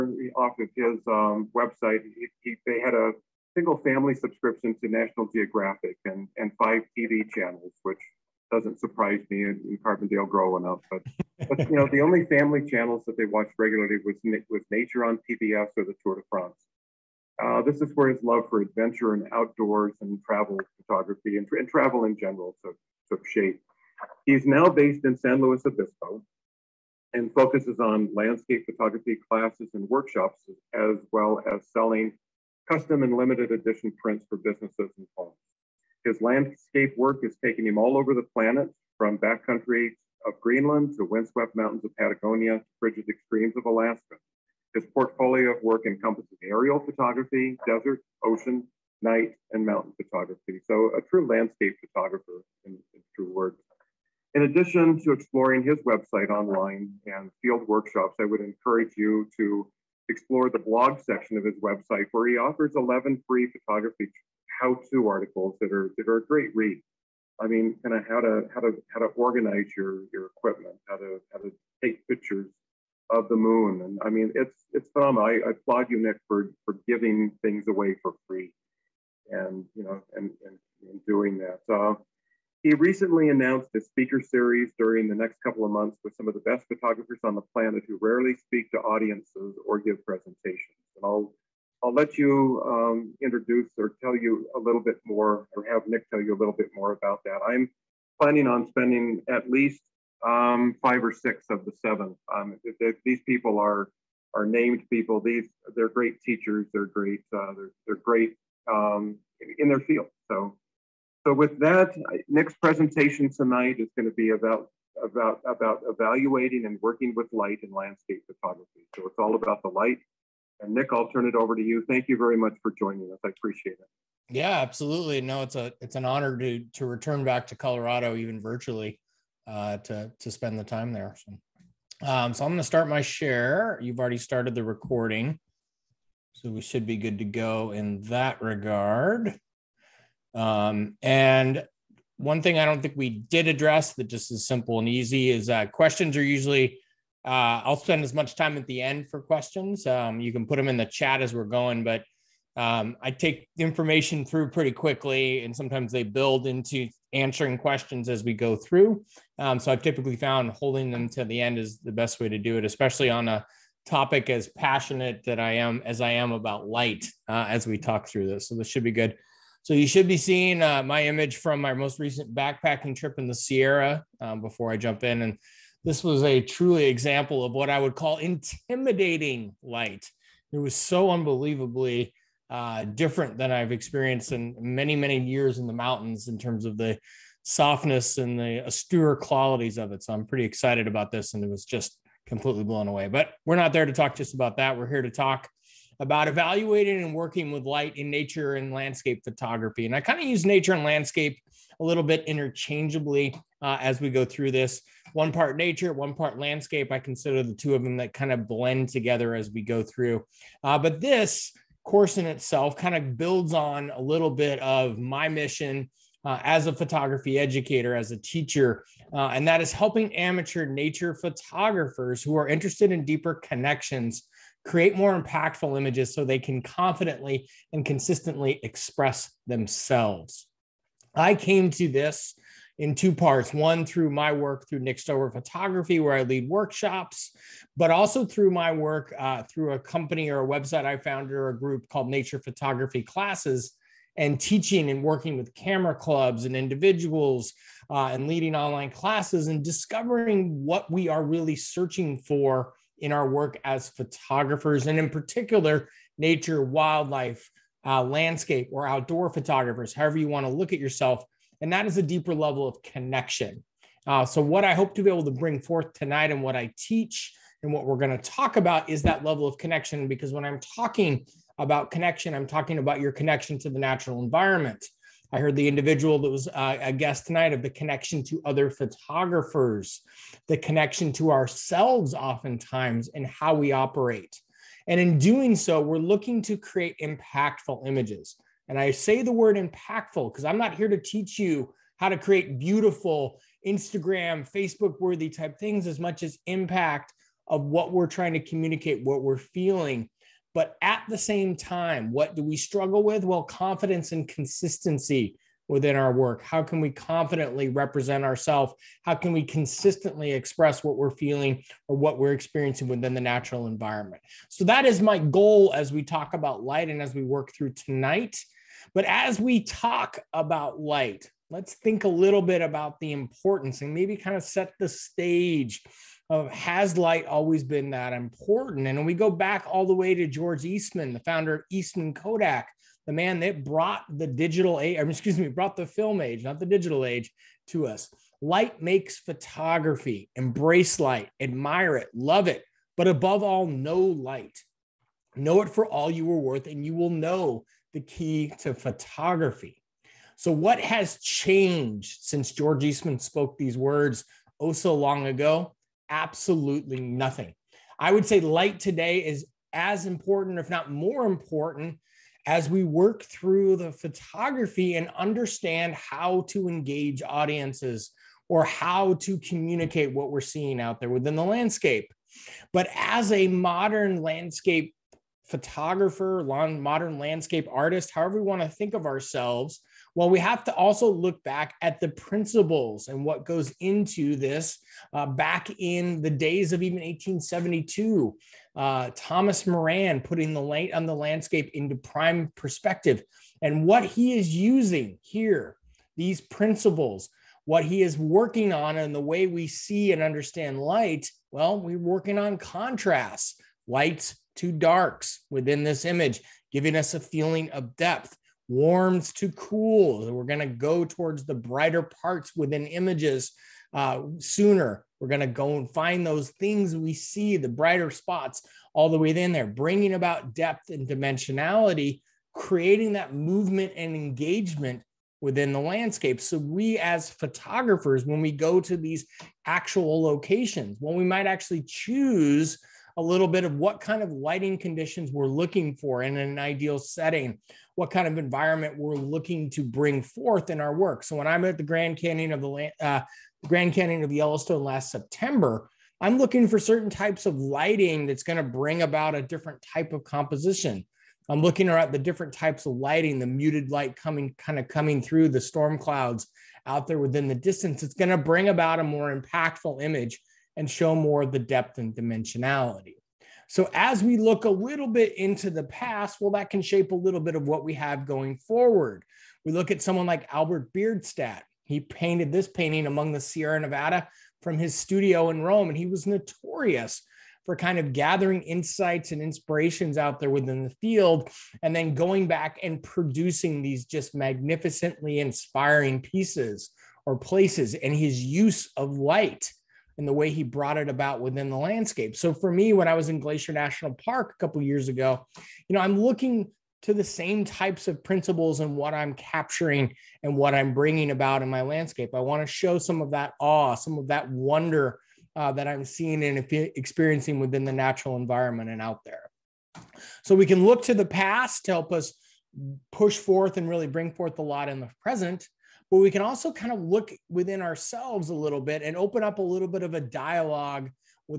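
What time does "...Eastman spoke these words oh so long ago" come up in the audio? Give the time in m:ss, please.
5:52.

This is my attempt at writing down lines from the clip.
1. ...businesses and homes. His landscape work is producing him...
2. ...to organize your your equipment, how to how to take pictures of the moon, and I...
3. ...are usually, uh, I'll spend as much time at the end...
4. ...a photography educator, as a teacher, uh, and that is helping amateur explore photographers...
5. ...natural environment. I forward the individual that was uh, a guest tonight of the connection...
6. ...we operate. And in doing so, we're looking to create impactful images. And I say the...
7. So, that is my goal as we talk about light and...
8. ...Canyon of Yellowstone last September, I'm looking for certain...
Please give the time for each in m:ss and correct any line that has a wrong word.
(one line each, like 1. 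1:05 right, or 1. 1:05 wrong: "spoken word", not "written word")
1. 0:34 wrong: "taking", not "producing"
2. 1:08 right
3. 2:26 right
4. 3:36 wrong: "nature", not "explore"
5. 4:33 wrong: "heard", not "forward"
6. 4:43 right
7. 5:14 right
8. 7:23 right.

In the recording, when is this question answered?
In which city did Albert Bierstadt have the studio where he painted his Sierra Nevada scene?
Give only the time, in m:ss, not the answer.
7:55.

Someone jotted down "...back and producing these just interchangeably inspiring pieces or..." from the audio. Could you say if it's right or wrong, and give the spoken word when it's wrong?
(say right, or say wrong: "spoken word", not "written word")
wrong: "magnificently", not "interchangeably".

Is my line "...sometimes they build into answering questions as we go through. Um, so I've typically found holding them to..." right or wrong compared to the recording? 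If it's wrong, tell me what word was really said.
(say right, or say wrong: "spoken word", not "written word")
right.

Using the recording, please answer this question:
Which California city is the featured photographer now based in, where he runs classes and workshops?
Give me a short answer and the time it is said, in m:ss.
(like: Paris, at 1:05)
San Luis Obispo, at 0:25.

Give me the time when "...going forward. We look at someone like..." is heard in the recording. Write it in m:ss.
7:48.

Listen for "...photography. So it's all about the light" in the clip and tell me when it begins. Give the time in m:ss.
1:58.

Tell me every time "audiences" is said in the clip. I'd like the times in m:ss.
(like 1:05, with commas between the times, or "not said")
1:28, 6:07.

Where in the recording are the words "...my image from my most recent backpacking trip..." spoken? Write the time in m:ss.
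2:50.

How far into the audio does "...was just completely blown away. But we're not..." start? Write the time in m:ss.
3:11.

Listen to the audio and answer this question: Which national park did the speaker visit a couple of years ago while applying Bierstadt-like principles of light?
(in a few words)
Glacier National Park.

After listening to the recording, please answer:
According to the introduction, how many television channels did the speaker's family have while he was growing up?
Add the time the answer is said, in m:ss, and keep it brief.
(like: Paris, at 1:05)
5, at 0:06.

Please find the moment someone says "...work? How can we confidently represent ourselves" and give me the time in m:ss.
5:06.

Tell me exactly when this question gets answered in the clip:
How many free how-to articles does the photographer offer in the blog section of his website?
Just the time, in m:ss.
1:02.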